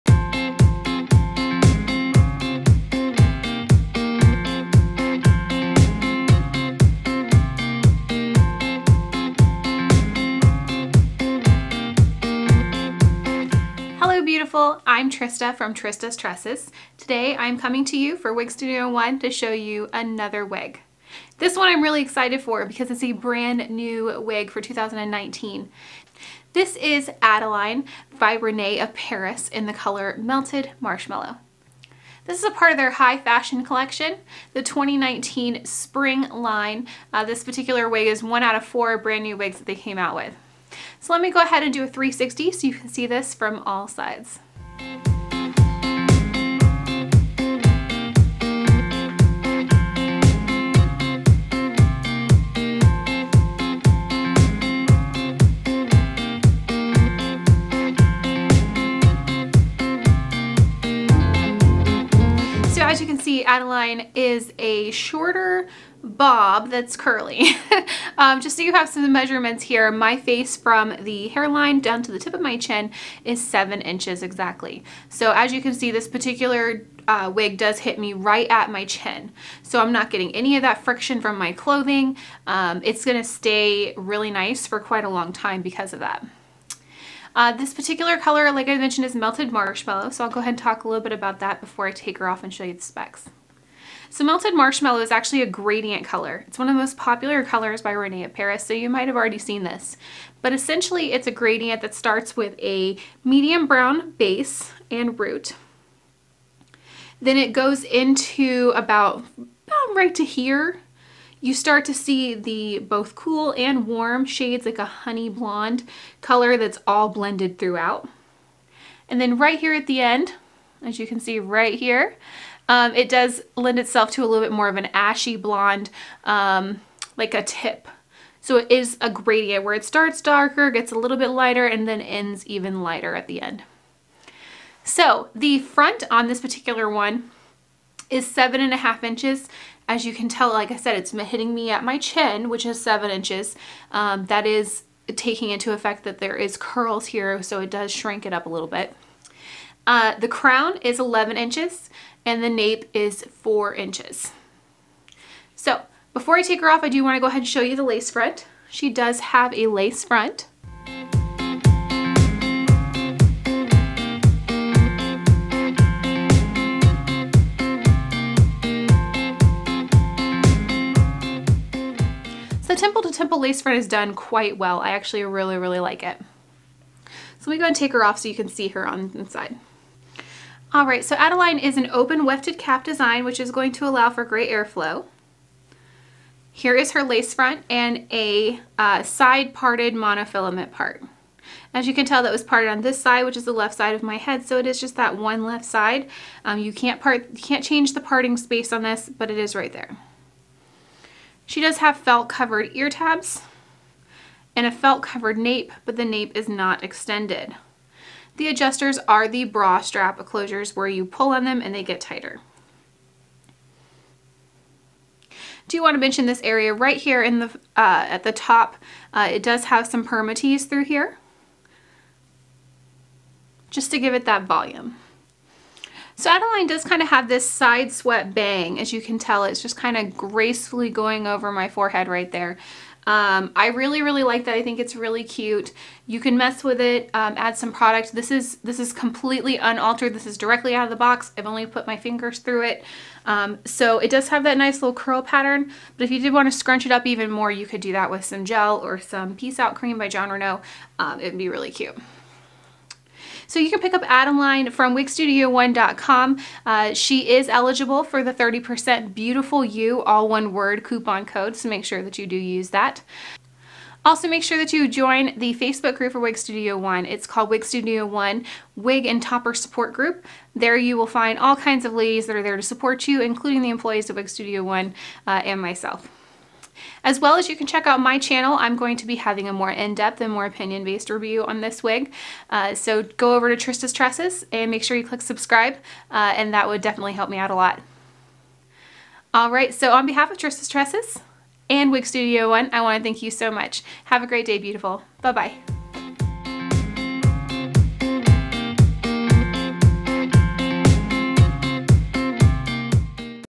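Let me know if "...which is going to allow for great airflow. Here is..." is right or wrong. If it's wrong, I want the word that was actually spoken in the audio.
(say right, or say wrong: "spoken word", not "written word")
right.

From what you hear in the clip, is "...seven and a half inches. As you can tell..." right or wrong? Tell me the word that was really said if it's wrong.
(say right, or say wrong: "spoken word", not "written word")
right.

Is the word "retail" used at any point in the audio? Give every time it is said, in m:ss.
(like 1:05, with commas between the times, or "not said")
not said.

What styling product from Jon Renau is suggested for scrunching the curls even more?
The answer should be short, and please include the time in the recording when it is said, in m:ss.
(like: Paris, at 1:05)
Peace Out Cream, at 4:09.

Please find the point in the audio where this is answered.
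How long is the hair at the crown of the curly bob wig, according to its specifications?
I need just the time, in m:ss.
2:30.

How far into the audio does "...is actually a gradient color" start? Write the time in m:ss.
1:34.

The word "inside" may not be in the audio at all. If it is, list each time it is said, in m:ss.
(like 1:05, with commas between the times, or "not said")
2:59.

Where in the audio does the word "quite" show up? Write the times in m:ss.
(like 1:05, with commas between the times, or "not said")
1:24, 2:54.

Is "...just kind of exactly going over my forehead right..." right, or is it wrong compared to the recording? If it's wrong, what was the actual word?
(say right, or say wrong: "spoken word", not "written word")
wrong: "gracefully", not "exactly".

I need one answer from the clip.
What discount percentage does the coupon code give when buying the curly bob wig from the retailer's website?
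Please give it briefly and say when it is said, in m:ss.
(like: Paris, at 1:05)
30%, at 4:18.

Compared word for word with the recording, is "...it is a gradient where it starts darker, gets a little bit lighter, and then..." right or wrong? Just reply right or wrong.
right.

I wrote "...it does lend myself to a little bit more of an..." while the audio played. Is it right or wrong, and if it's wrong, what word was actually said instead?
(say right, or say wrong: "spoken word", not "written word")
wrong: "itself", not "myself".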